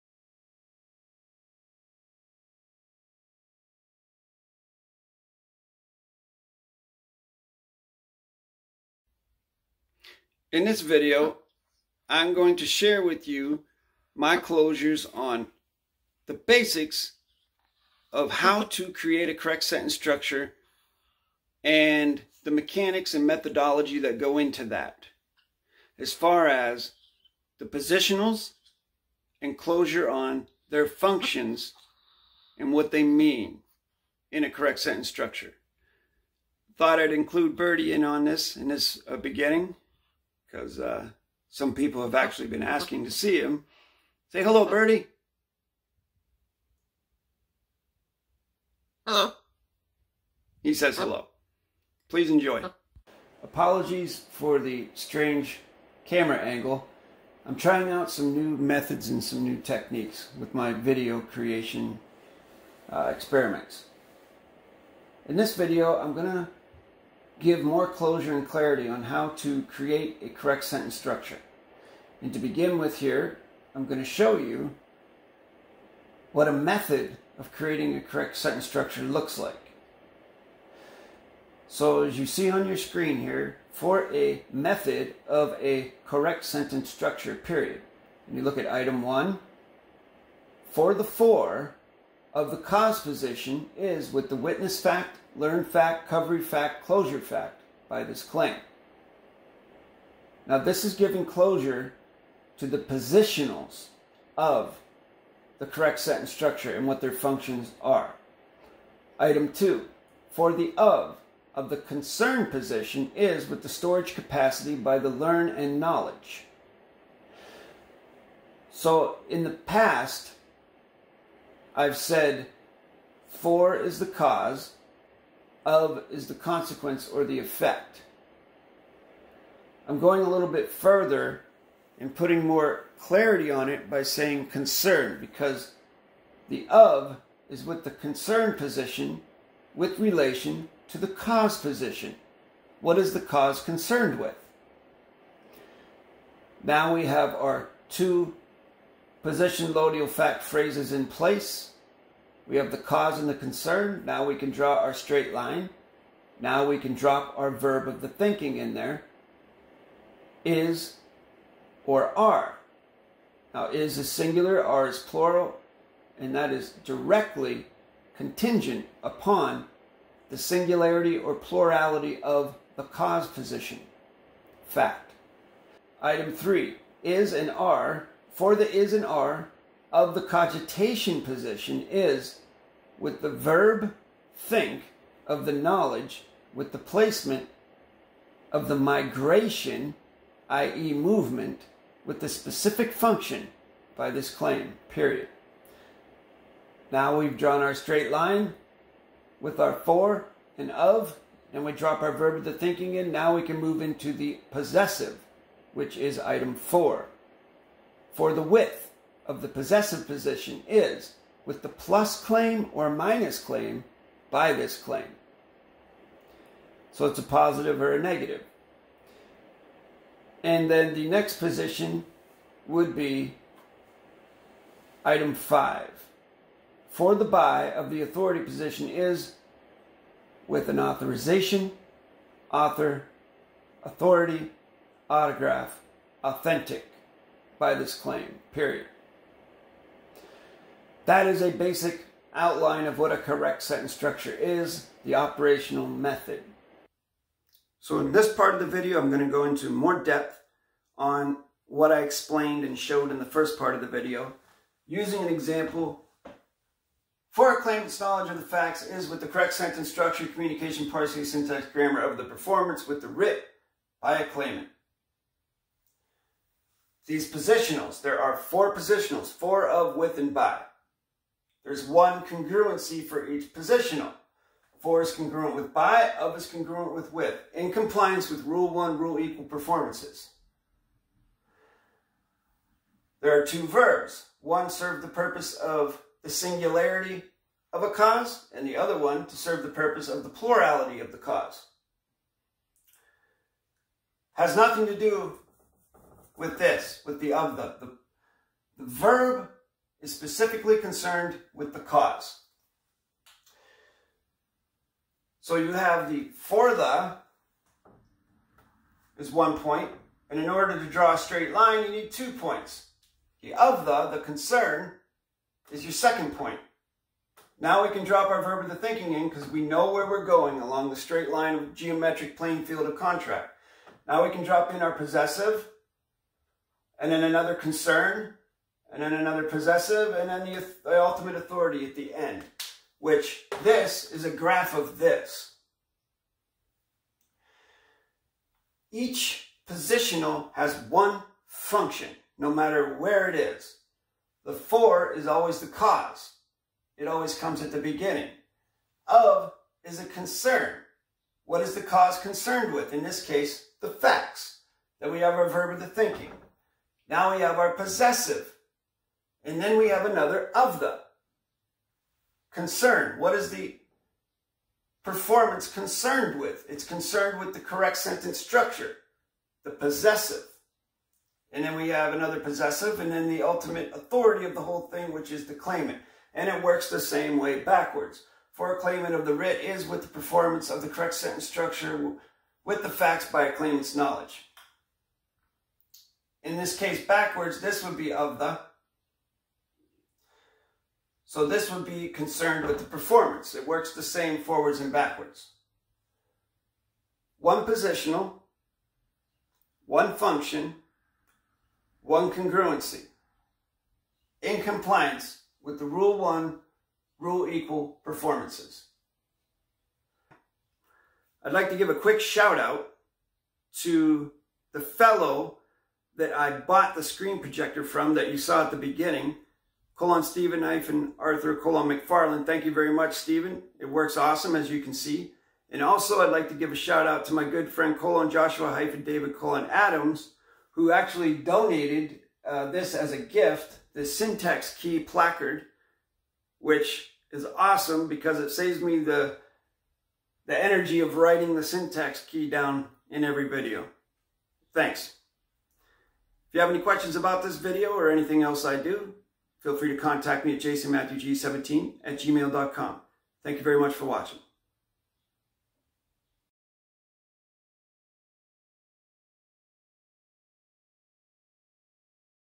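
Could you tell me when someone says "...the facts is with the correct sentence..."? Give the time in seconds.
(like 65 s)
258 s.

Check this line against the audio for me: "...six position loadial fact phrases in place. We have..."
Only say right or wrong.
wrong.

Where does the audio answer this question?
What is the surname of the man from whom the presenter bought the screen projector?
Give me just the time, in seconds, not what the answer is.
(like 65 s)
421 s.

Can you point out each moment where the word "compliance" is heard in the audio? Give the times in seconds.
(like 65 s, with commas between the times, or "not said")
277 s, 404 s.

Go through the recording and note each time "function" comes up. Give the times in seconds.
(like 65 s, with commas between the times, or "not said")
30 s, 107 s, 192 s, 341 s, 400 s.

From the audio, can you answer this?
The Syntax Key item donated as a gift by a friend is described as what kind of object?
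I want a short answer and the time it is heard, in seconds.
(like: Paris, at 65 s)
placard, at 435 s.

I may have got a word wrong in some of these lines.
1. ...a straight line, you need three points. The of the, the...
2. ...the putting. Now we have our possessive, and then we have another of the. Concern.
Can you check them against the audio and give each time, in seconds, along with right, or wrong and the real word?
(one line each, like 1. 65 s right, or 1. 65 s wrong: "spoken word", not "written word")
1. 311 s wrong: "two", not "three"
2. 355 s wrong: "thinking", not "putting".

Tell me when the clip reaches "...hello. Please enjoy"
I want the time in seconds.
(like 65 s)
50 s.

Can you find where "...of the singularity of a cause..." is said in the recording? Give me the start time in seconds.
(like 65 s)
285 s.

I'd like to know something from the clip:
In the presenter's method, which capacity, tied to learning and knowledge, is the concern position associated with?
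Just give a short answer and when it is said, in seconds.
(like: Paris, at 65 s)
storage capacity, at 113 s.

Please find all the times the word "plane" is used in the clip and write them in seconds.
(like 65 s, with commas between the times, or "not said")
322 s.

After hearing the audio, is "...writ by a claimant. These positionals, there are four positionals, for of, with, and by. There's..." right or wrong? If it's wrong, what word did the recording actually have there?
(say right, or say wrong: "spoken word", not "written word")
right.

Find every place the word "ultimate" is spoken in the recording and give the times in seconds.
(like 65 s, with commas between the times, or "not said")
331 s, 373 s.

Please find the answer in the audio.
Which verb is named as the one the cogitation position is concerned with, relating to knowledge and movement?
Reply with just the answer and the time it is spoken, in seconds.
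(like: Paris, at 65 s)
think, at 184 s.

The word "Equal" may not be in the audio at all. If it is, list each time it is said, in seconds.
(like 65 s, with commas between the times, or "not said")
279 s, 407 s.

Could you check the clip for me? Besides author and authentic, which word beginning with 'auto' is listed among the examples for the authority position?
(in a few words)
autograph.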